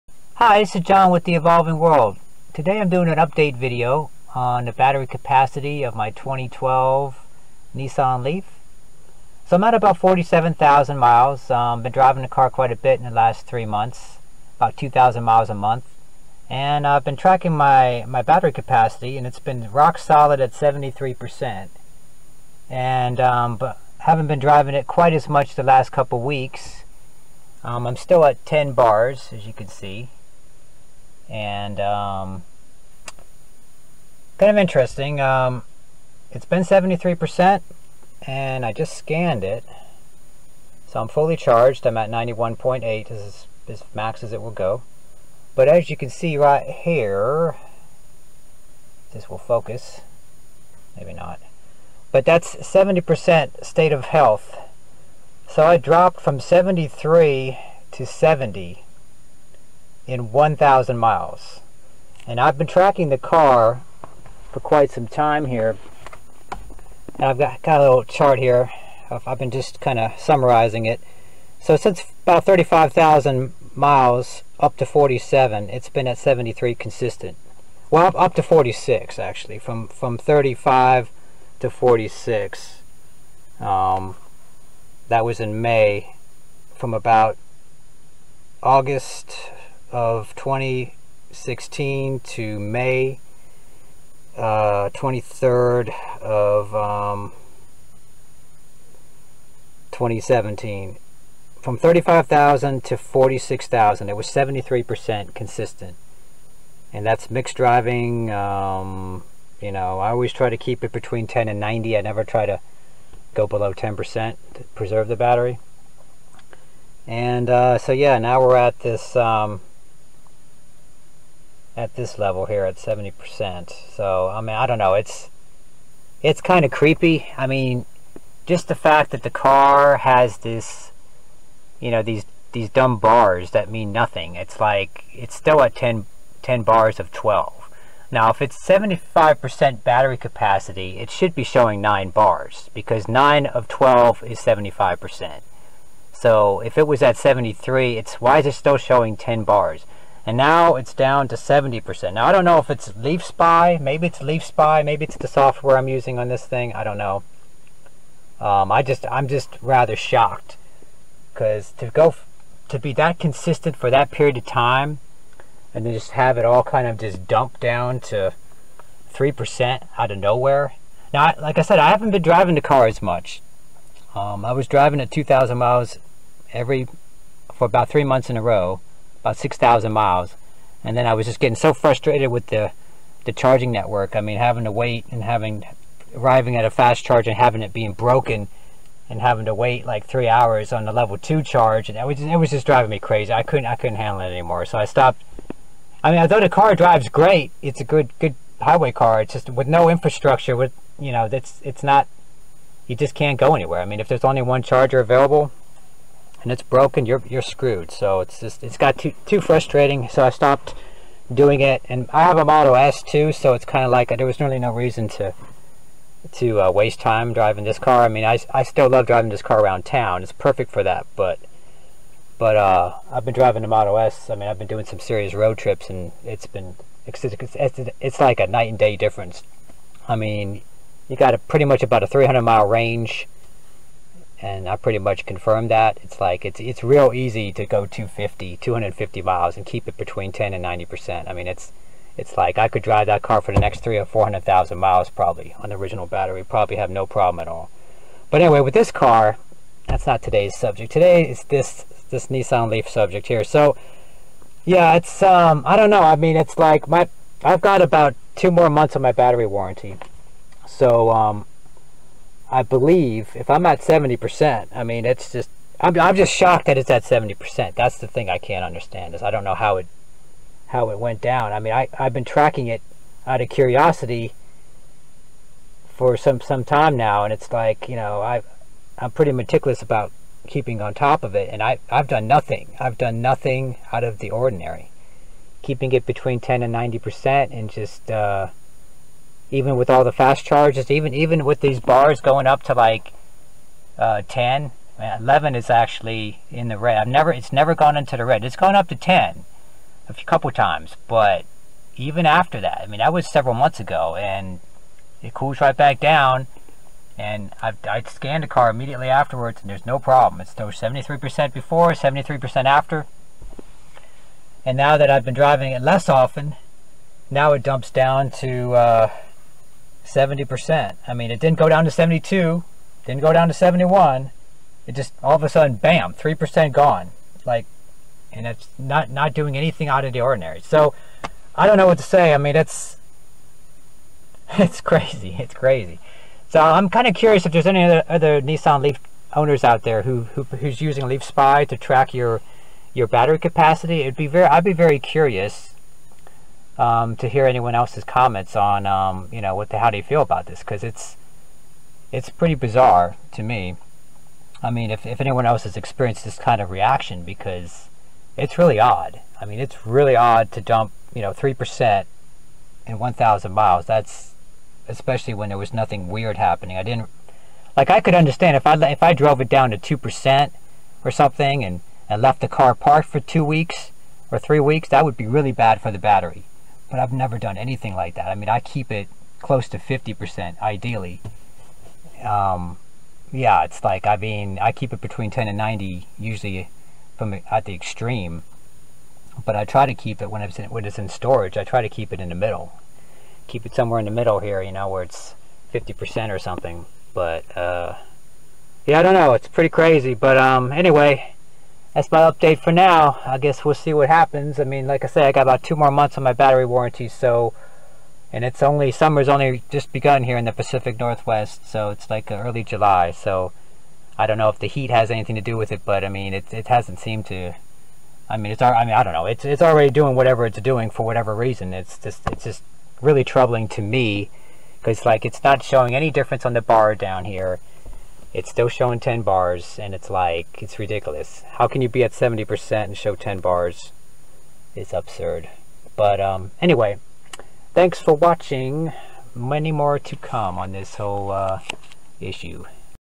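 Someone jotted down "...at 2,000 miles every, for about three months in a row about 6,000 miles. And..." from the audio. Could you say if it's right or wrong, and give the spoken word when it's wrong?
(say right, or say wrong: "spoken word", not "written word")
right.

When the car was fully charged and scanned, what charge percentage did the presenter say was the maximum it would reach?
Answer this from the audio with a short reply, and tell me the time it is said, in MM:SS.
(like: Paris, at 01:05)
91.8, at 00:42.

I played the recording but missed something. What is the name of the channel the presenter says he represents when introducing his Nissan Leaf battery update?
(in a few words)
The Evolving World.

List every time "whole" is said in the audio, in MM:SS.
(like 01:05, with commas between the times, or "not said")
07:20.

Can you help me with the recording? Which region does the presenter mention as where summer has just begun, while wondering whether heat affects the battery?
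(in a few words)
Pacific Northwest.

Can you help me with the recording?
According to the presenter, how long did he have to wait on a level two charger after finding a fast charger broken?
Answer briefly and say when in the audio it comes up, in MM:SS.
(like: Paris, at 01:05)
3 hours, at 03:10.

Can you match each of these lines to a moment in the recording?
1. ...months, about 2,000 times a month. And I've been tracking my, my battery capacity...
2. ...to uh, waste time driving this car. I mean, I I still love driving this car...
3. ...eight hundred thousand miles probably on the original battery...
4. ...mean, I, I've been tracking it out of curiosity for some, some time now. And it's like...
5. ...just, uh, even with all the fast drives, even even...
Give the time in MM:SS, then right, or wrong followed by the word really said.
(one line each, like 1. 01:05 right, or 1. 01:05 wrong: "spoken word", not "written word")
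1. 00:13 wrong: "miles", not "times"
2. 03:36 right
3. 04:04 wrong: "four", not "eight"
4. 04:31 right
5. 04:47 wrong: "charges", not "drives".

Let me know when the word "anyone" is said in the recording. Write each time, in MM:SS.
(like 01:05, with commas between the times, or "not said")
05:47, 05:55.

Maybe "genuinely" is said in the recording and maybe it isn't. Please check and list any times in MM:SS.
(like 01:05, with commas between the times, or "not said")
not said.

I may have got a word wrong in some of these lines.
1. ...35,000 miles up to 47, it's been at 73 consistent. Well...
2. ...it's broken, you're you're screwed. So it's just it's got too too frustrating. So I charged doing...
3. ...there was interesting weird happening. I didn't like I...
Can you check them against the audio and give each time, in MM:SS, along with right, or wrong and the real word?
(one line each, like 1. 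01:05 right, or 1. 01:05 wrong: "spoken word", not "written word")
1. 01:12 right
2. 03:26 wrong: "stopped", not "charged"
3. 06:05 wrong: "nothing", not "interesting".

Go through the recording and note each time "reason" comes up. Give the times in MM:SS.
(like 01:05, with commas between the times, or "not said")
03:34, 07:01.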